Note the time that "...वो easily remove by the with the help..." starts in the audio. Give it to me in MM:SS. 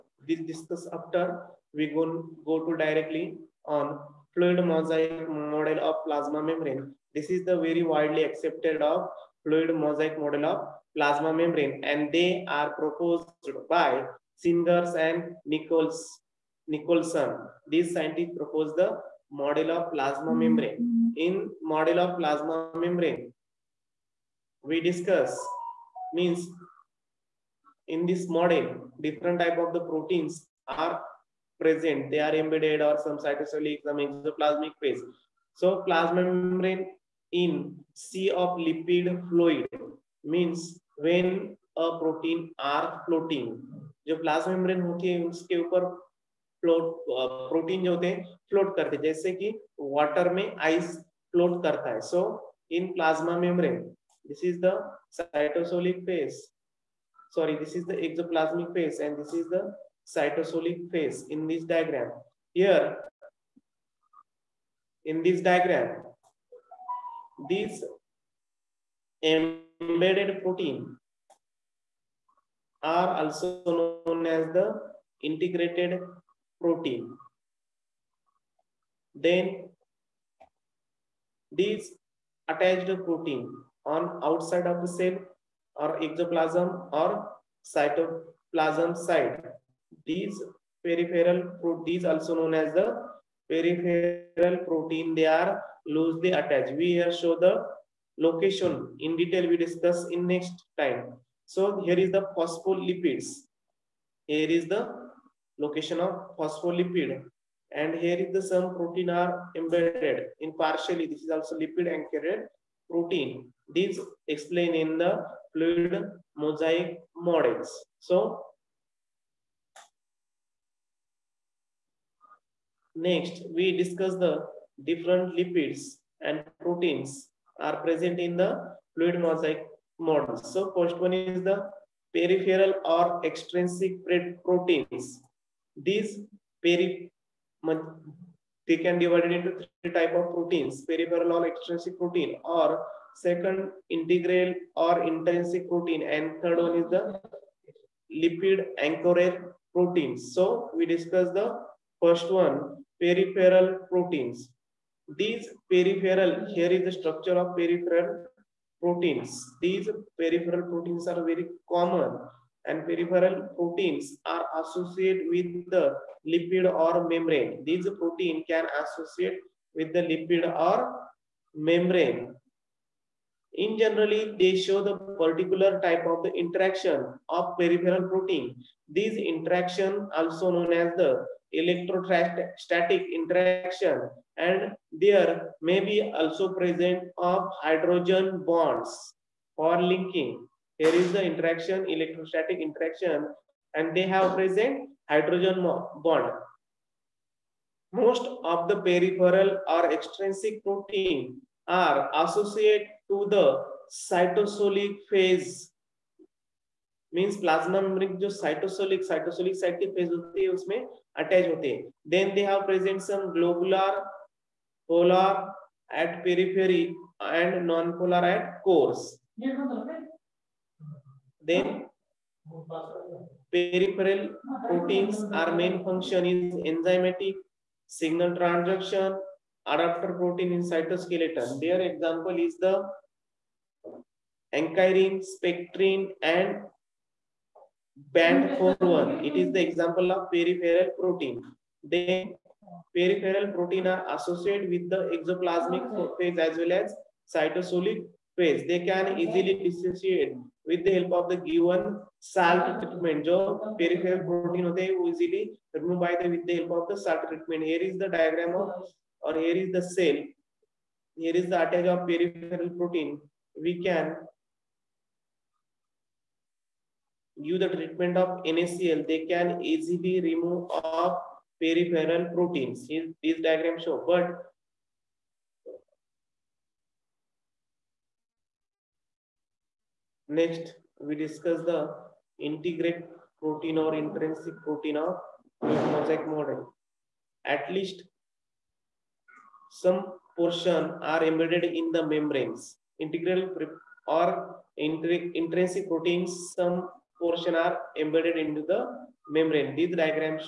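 04:14.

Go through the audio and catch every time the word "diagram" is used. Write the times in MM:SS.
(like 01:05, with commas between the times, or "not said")
04:18, 04:33, 04:59.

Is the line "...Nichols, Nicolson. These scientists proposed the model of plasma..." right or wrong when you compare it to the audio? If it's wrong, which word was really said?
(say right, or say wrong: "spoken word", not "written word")
right.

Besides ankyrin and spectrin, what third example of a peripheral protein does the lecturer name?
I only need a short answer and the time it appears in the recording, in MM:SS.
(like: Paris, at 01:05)
Band 4.1, at 03:58.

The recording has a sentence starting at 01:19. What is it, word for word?
Then these attached protein on outside of the cell or exoplasm or cytoplasm side.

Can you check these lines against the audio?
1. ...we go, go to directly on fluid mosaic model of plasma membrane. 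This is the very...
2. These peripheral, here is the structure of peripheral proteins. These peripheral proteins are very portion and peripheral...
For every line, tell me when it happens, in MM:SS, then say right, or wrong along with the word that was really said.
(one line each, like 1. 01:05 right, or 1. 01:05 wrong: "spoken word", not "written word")
1. 00:01 right
2. 02:35 wrong: "common", not "portion".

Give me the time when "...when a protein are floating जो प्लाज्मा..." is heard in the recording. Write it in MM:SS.
00:40.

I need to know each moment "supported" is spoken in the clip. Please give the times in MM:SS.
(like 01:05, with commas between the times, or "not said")
not said.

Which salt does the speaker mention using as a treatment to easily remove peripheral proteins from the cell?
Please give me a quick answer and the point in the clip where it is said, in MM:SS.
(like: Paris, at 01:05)
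NaCl, at 04:28.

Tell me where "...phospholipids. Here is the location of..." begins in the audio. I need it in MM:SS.
01:42.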